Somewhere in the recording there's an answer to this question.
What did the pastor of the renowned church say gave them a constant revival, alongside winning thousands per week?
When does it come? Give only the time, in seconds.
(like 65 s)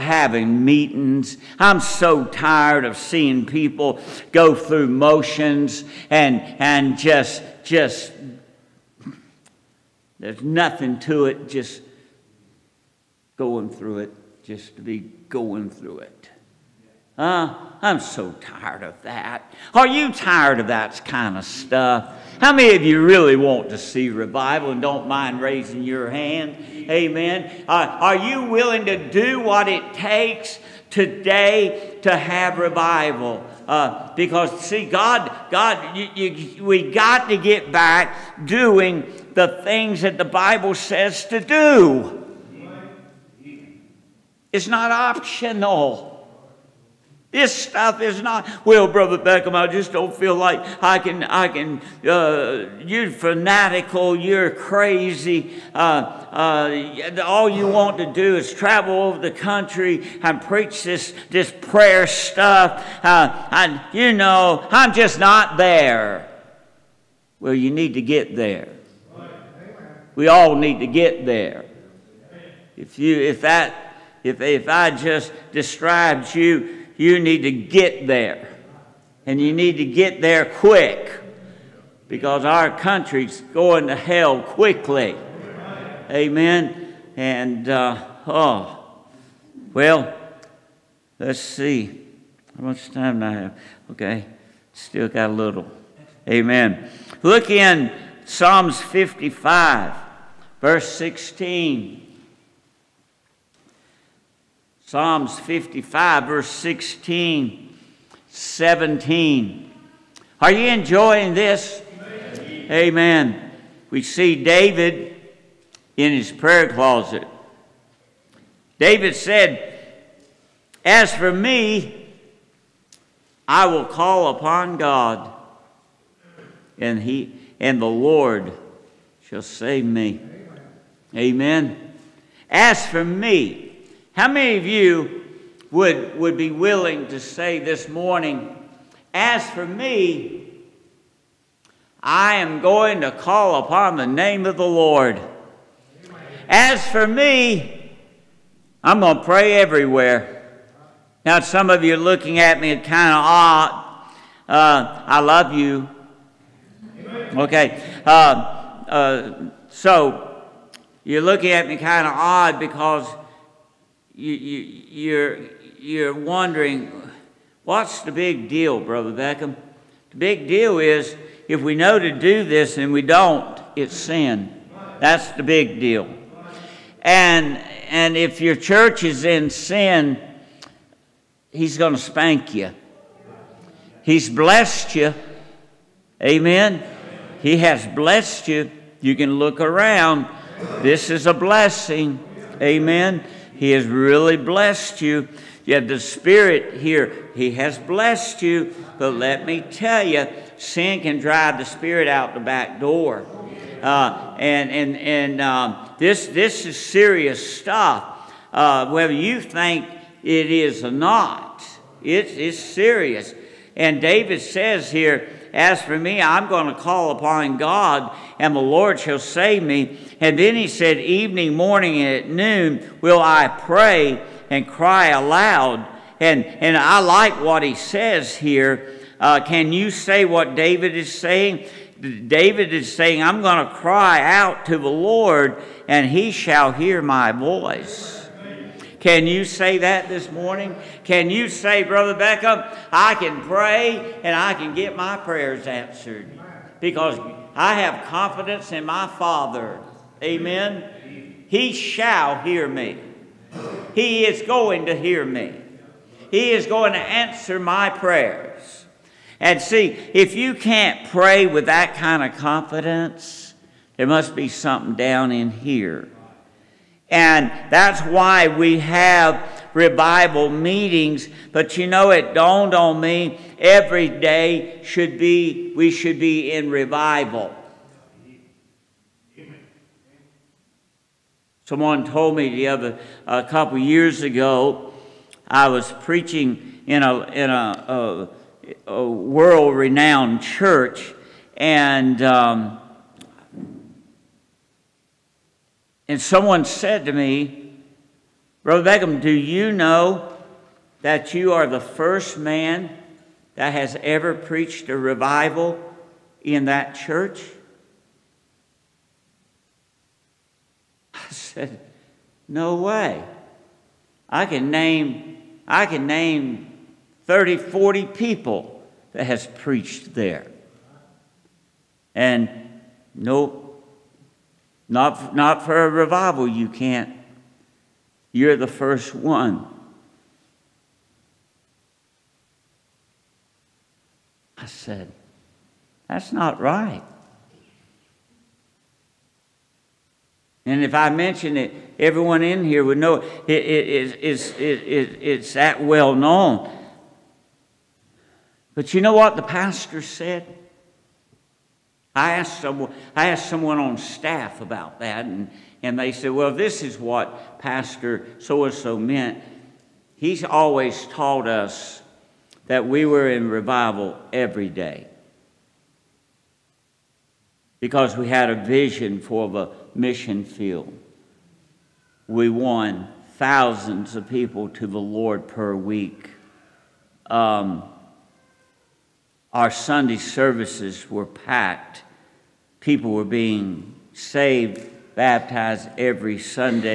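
368 s.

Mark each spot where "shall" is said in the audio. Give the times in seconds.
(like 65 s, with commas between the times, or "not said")
129 s, 218 s, 236 s, 251 s.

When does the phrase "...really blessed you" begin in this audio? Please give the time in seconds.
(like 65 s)
193 s.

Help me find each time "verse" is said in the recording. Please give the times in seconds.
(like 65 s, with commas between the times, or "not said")
100 s, 106 s.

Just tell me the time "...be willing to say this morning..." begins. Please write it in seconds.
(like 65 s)
136 s.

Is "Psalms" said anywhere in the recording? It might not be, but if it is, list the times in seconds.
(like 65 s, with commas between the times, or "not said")
98 s, 104 s.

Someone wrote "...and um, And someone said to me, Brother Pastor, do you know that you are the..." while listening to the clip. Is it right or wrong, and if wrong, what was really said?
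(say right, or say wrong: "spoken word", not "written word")
wrong: "Beckham", not "Pastor".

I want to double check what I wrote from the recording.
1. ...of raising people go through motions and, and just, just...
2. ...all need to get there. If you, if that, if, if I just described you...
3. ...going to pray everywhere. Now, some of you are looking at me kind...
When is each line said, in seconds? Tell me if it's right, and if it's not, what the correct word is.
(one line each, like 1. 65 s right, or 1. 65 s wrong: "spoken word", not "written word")
1. 2 s wrong: "seeing", not "raising"
2. 70 s right
3. 148 s right.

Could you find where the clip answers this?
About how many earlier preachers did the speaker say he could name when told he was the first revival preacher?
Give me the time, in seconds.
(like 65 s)
317 s.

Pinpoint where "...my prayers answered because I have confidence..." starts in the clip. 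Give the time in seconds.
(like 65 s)
244 s.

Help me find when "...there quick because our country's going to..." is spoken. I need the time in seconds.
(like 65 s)
80 s.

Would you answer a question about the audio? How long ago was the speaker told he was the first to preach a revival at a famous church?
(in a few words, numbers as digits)
A couple years ago.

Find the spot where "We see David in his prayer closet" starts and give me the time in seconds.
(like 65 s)
113 s.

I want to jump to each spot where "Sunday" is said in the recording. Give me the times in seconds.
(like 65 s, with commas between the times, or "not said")
379 s, 386 s.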